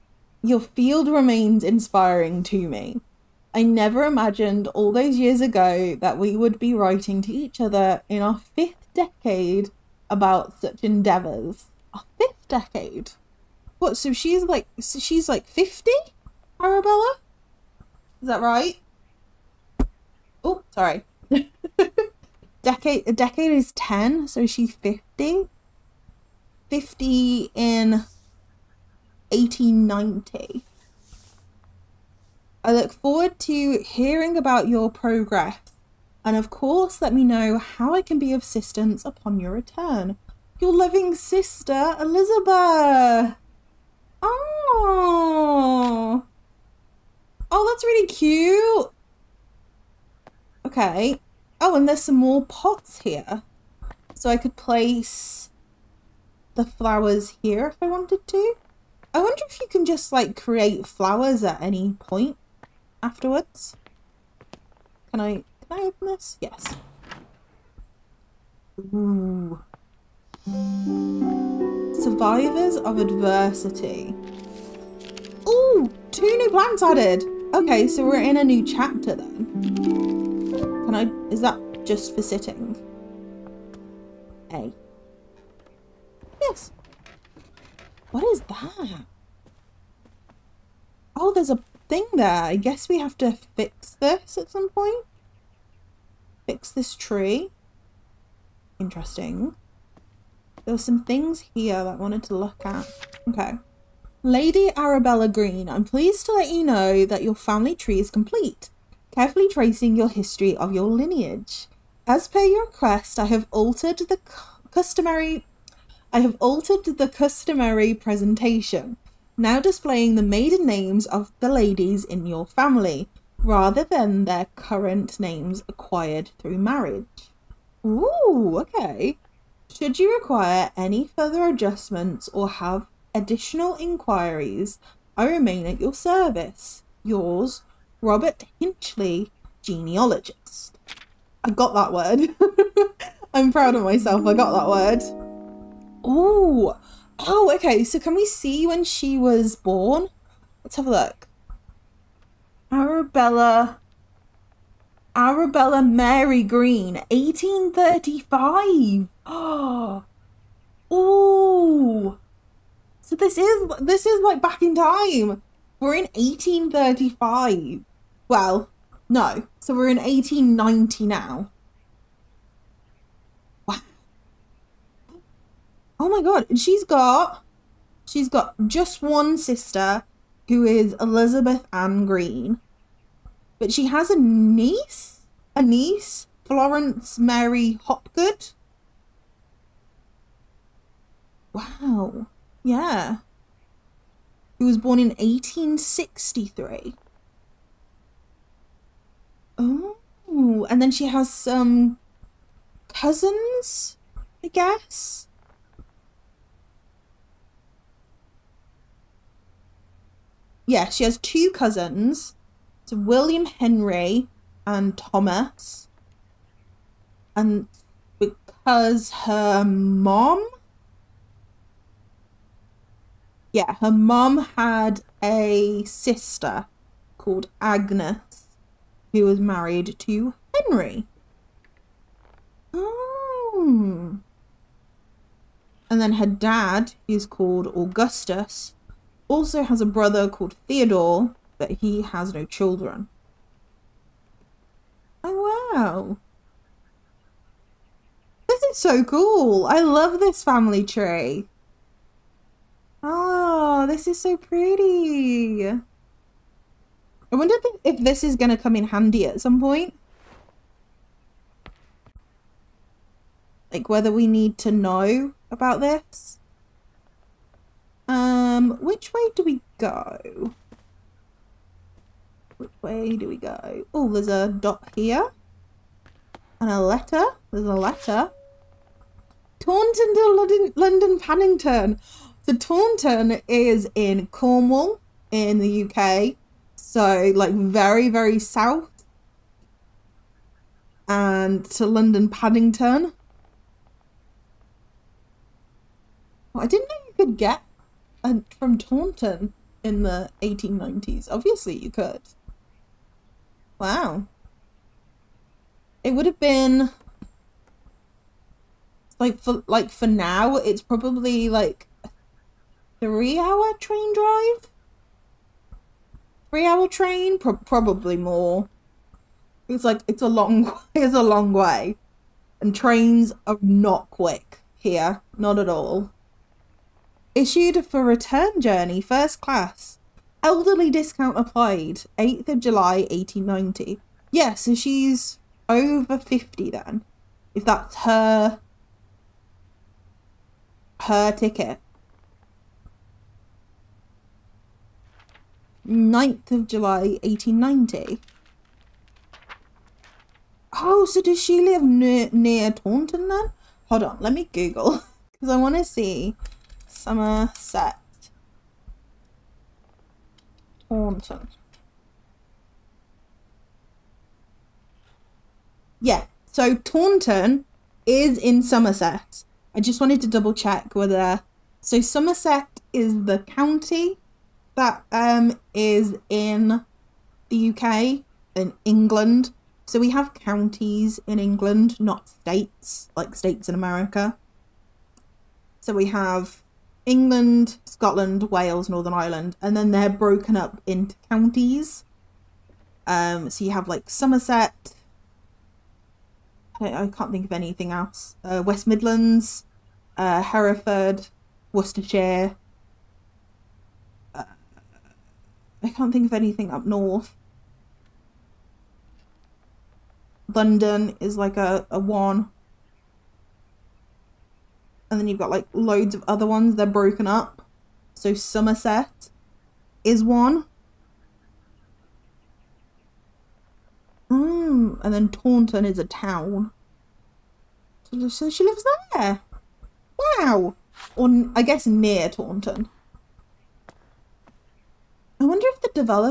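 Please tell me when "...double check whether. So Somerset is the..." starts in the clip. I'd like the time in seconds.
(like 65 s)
370 s.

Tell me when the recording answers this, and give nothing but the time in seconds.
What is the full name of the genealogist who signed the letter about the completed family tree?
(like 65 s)
137 s.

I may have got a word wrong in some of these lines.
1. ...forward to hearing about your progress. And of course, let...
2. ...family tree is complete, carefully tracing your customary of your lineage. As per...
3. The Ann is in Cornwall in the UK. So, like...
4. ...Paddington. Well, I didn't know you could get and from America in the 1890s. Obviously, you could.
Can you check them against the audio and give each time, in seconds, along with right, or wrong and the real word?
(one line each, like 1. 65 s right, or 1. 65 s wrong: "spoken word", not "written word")
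1. 32 s right
2. 107 s wrong: "history", not "customary"
3. 282 s wrong: "Taunton", not "Ann"
4. 292 s wrong: "Taunton", not "America".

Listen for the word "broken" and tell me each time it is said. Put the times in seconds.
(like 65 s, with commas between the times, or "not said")
390 s, 416 s.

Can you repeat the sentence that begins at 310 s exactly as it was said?
It's probably like three-hour train drive.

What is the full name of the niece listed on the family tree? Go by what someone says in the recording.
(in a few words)
Florence Mary Hopgood.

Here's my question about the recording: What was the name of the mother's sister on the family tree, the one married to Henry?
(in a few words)
Agnes.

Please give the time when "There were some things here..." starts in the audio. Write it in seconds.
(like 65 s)
100 s.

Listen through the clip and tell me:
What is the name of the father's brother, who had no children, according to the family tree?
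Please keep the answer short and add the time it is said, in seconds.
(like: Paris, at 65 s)
Theodore, at 240 s.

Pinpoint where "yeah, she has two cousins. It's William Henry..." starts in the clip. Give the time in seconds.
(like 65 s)
210 s.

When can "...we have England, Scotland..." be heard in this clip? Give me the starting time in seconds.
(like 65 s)
385 s.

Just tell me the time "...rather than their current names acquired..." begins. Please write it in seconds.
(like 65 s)
123 s.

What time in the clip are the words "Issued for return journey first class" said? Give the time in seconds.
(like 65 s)
327 s.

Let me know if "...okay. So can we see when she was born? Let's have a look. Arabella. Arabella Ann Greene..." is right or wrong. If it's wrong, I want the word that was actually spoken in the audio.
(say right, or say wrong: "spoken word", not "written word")
wrong: "Mary", not "Ann".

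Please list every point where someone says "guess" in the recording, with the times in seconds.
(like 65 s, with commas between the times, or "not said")
92 s, 204 s, 431 s.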